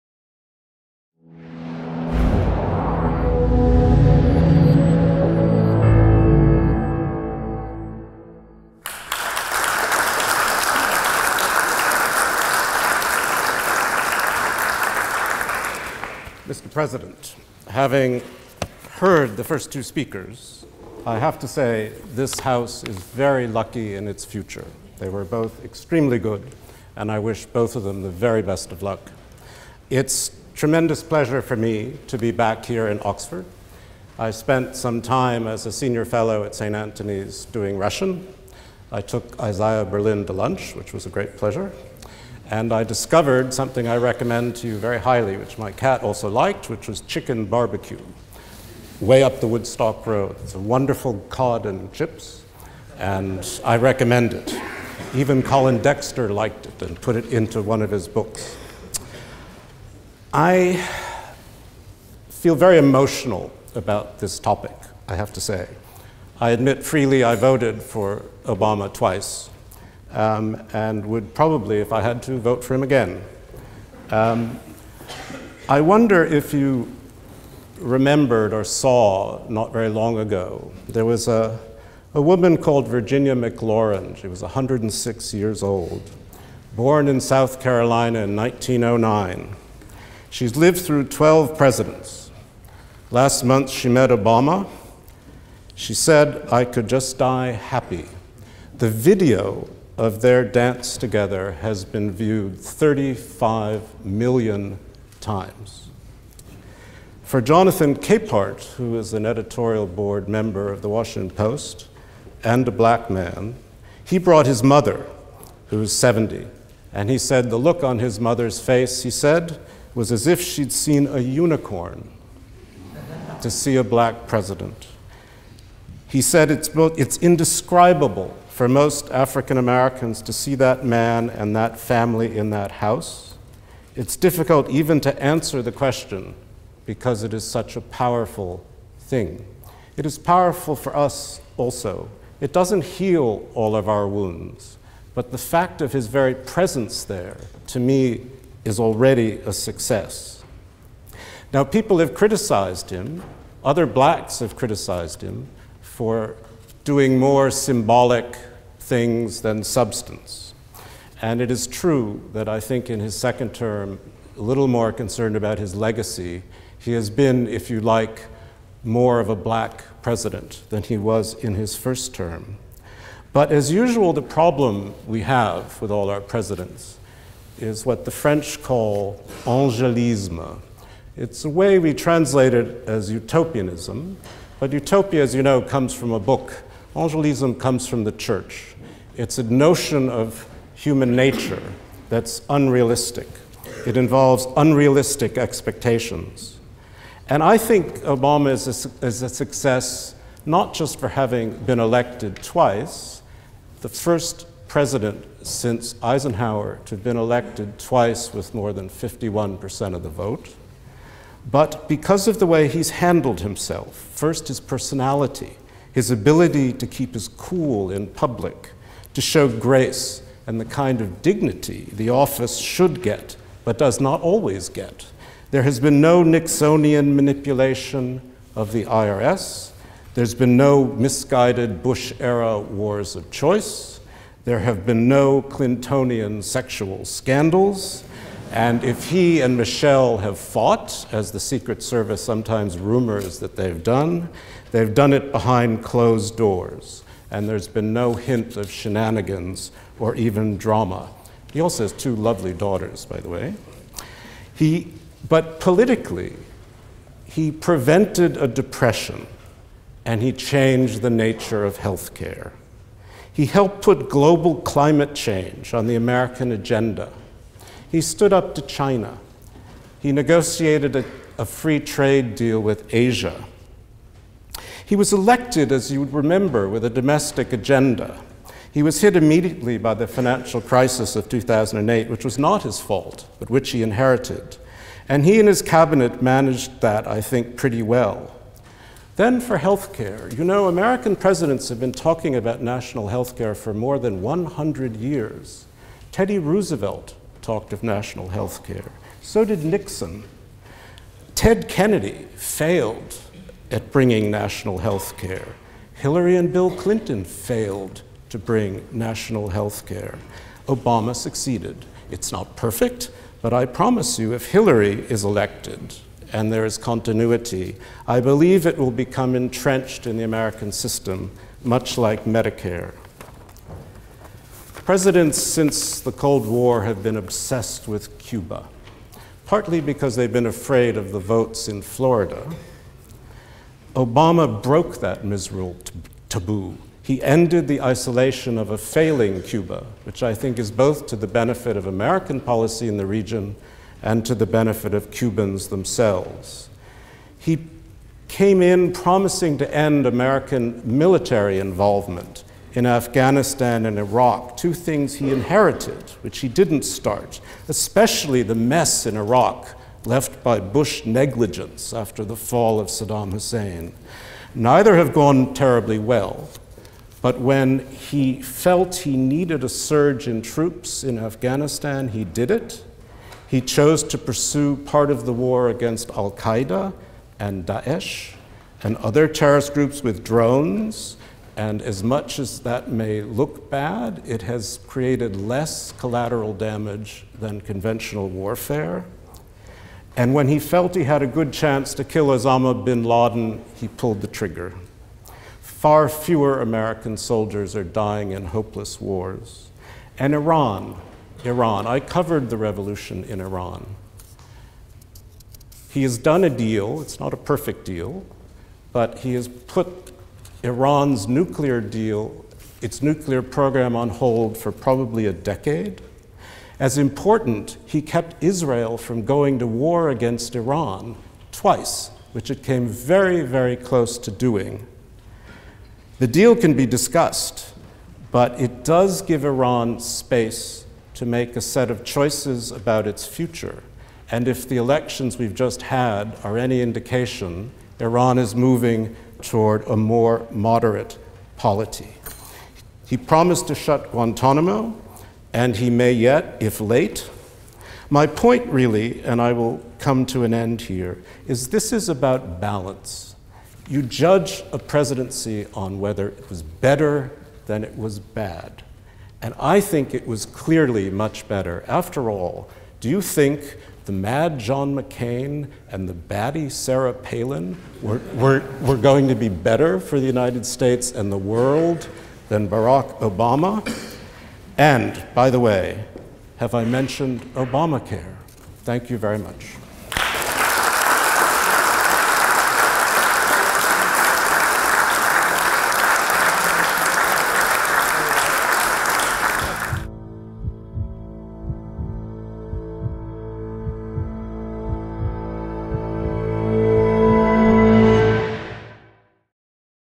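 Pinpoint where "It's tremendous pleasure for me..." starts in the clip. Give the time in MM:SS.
00:29.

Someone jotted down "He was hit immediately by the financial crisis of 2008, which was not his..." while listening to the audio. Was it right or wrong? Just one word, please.
right.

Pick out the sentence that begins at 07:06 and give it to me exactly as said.
The deal can be discussed, but it does give Iran space to make a set of choices about its future.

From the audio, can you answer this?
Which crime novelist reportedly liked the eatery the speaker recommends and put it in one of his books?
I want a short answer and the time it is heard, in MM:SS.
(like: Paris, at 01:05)
Colin Dexter, at 00:55.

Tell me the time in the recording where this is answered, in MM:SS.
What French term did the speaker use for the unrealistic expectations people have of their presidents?
02:59.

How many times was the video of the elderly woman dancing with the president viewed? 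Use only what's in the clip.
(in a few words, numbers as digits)
35 million.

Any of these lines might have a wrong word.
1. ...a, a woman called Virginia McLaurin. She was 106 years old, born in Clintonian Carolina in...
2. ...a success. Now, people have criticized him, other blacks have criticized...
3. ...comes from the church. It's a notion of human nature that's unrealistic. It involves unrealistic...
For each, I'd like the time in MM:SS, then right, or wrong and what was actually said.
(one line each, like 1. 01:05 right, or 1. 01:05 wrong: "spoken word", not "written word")
1. 01:21 wrong: "South", not "Clintonian"
2. 02:29 right
3. 03:07 right.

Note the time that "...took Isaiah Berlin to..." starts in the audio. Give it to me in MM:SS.
00:39.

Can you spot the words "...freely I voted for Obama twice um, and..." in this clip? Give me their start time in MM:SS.
01:06.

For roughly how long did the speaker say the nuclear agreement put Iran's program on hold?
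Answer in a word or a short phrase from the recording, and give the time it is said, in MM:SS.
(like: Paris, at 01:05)
a decade, at 06:55.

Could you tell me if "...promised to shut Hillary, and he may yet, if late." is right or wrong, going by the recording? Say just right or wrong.
wrong.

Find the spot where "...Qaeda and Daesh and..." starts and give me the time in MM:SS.
06:16.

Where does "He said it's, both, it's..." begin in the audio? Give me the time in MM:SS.
02:06.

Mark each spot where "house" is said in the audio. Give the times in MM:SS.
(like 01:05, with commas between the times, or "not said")
00:22, 02:12.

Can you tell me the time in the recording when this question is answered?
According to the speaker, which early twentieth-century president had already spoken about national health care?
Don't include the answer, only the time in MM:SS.
04:56.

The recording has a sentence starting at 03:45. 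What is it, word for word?
There has been no Nixonian manipulation of the IRS.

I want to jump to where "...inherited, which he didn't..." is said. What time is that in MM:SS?
05:55.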